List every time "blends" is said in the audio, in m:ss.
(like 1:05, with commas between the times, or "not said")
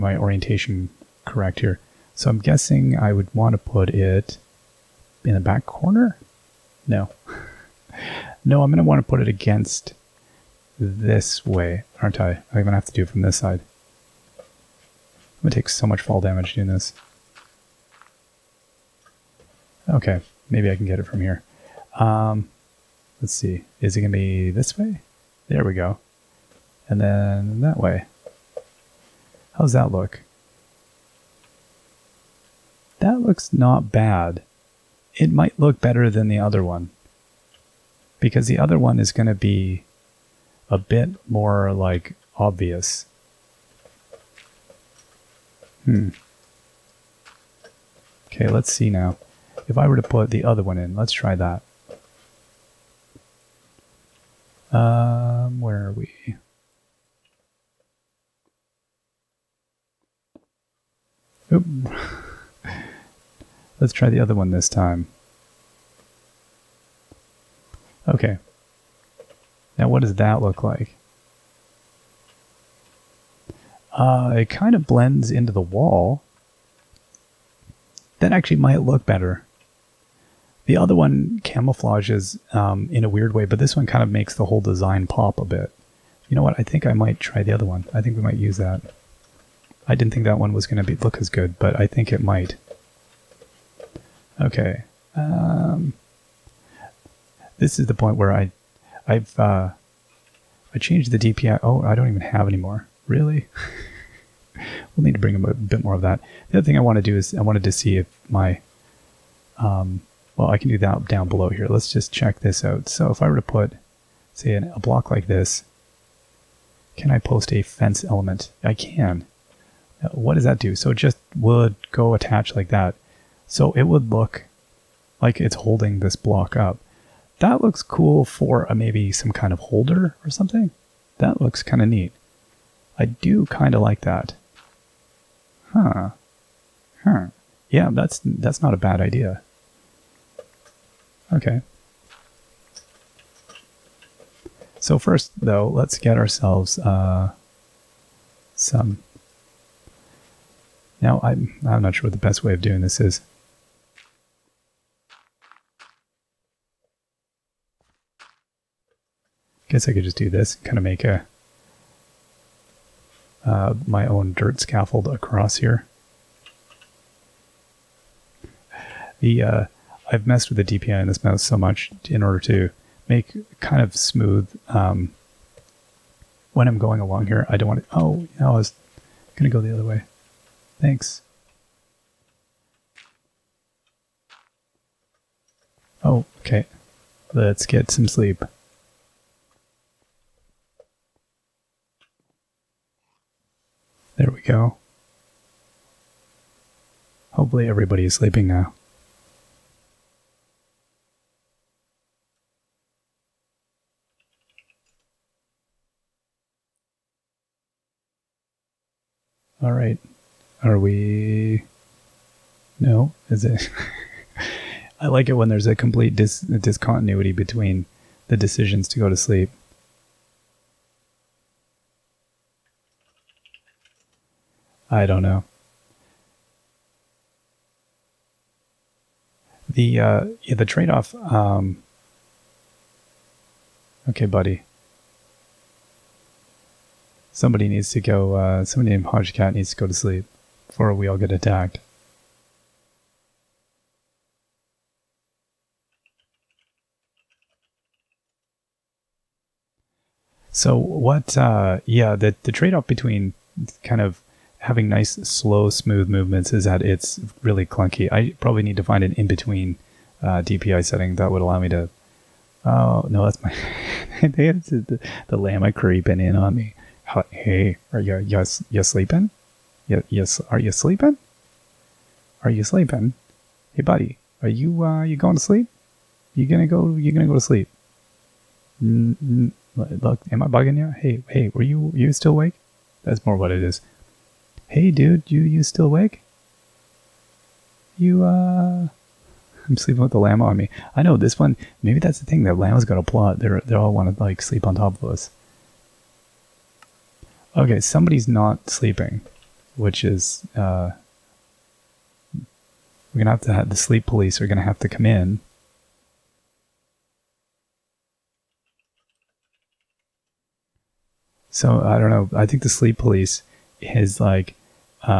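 1:14.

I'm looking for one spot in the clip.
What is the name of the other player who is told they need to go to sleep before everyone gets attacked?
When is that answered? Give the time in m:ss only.
3:59.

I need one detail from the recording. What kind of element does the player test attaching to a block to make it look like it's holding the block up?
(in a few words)
fence.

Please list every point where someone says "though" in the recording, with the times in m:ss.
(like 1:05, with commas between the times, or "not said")
2:25.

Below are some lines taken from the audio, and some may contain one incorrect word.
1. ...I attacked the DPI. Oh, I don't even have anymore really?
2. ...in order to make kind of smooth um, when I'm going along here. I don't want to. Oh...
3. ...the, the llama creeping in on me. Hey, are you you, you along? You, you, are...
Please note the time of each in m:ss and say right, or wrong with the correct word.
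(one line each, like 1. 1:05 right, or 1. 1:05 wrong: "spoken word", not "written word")
1. 1:40 wrong: "changed", not "attacked"
2. 2:52 right
3. 4:24 wrong: "sleeping", not "along".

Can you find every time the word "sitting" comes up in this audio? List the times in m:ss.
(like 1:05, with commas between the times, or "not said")
not said.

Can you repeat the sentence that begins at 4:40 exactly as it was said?
Hey, hey, were you you still awake?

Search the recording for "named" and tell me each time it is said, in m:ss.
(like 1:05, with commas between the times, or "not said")
3:58.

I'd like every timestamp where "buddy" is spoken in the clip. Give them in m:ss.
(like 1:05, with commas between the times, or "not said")
3:54, 4:33.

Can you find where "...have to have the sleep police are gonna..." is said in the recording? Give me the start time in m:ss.
5:03.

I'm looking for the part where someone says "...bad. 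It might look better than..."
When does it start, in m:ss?
0:33.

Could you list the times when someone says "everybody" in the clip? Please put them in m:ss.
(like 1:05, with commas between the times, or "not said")
3:17.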